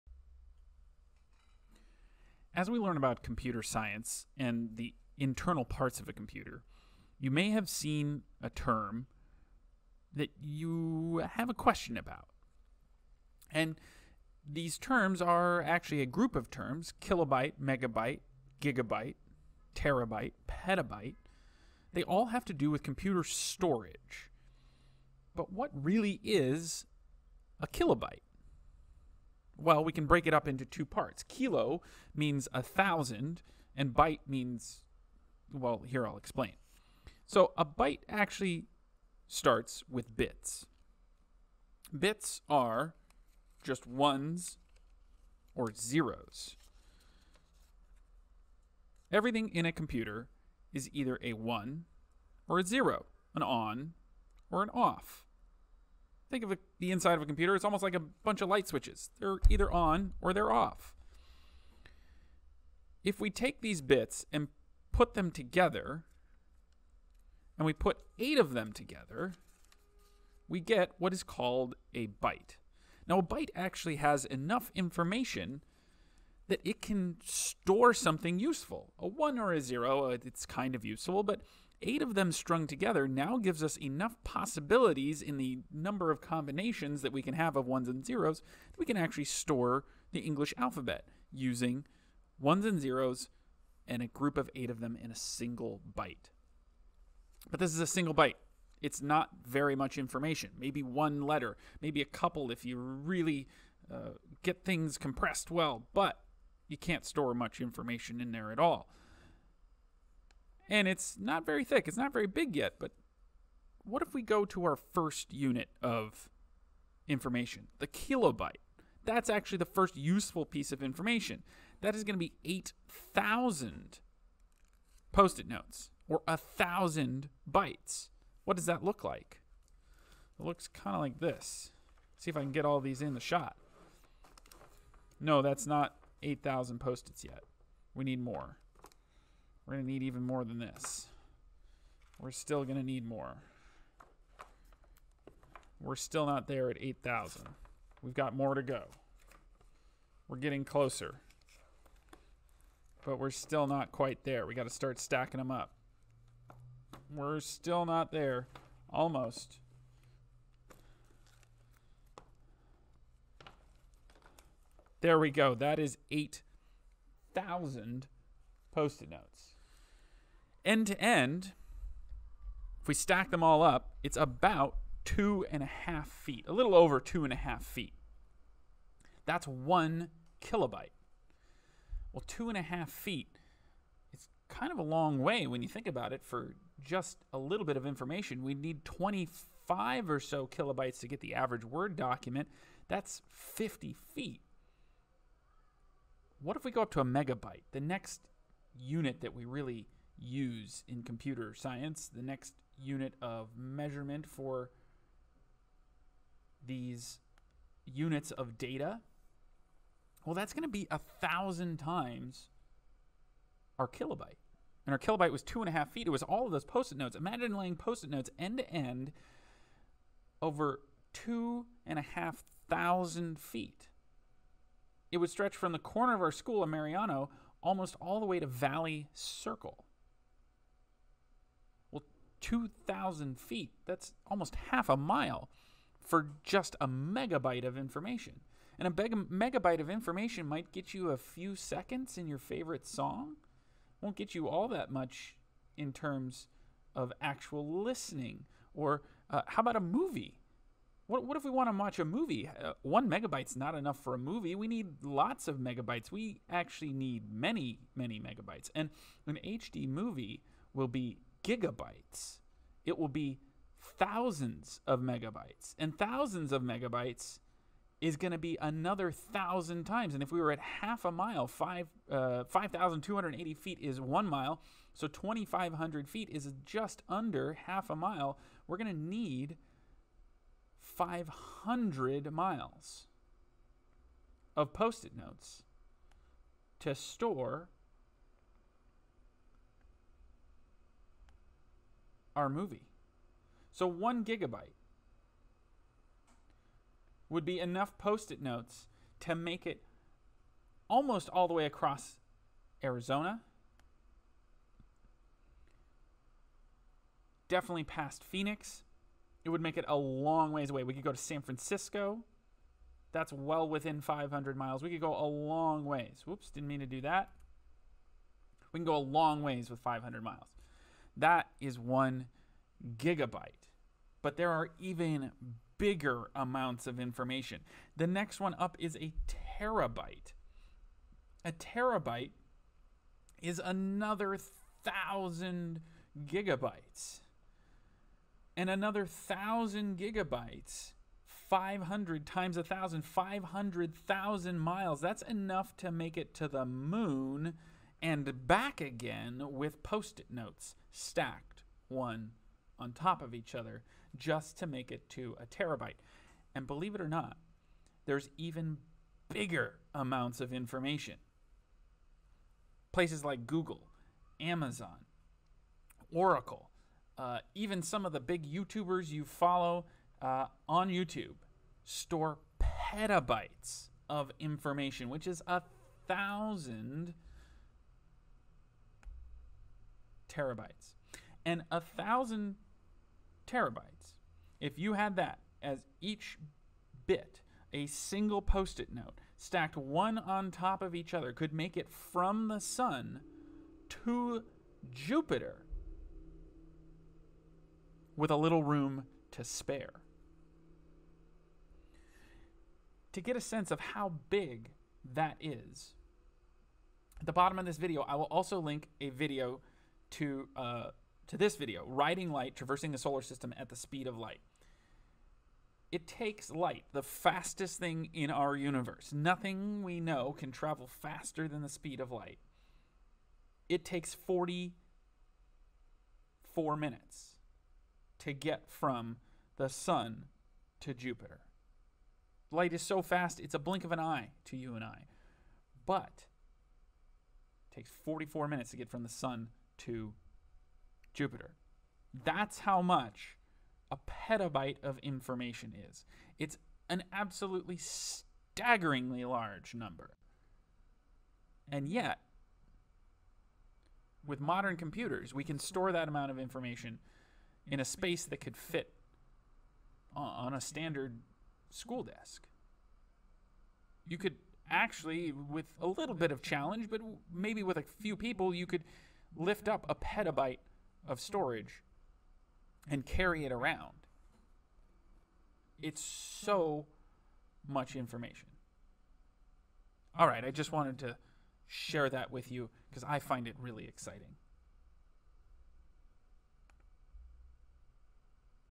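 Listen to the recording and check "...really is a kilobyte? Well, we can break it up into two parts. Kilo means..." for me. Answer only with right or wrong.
right.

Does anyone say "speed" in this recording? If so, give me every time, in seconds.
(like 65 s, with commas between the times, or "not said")
413 s, 421 s.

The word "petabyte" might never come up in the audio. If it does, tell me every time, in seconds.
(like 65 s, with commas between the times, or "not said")
20 s, 372 s, 443 s, 469 s.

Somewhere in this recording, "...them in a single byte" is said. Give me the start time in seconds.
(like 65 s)
94 s.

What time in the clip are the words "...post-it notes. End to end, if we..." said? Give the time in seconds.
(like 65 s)
168 s.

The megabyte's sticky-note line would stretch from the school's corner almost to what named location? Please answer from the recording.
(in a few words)
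Valley Circle.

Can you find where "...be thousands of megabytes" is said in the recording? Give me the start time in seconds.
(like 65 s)
263 s.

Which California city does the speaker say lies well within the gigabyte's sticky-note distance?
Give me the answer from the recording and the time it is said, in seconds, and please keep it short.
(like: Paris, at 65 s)
San Francisco, at 311 s.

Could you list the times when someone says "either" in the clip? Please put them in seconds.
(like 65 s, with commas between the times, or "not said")
50 s, 59 s.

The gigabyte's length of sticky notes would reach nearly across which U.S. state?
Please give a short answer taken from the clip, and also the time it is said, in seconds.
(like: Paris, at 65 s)
Arizona, at 302 s.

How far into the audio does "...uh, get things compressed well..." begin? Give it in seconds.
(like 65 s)
103 s.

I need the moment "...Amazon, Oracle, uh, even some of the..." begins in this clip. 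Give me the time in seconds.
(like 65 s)
364 s.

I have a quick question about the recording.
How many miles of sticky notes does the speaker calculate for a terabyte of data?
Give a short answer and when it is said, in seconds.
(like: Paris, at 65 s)
500,000 miles, at 343 s.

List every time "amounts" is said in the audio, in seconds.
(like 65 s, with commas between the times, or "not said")
326 s, 359 s, 456 s.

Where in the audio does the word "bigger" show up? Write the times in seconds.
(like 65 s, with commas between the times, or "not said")
325 s, 359 s.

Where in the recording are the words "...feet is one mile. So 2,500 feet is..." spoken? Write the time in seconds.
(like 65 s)
273 s.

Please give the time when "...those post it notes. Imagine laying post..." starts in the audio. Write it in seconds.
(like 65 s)
216 s.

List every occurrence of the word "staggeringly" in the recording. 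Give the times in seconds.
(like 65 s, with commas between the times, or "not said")
447 s.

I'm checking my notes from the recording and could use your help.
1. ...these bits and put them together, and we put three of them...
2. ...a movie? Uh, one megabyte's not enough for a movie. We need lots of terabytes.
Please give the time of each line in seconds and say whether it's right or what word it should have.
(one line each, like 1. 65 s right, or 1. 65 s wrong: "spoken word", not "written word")
1. 63 s wrong: "eight", not "three"
2. 251 s wrong: "megabytes", not "terabytes".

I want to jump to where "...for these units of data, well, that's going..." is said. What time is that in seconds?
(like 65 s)
204 s.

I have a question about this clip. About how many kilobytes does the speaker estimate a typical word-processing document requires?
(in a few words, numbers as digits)
25.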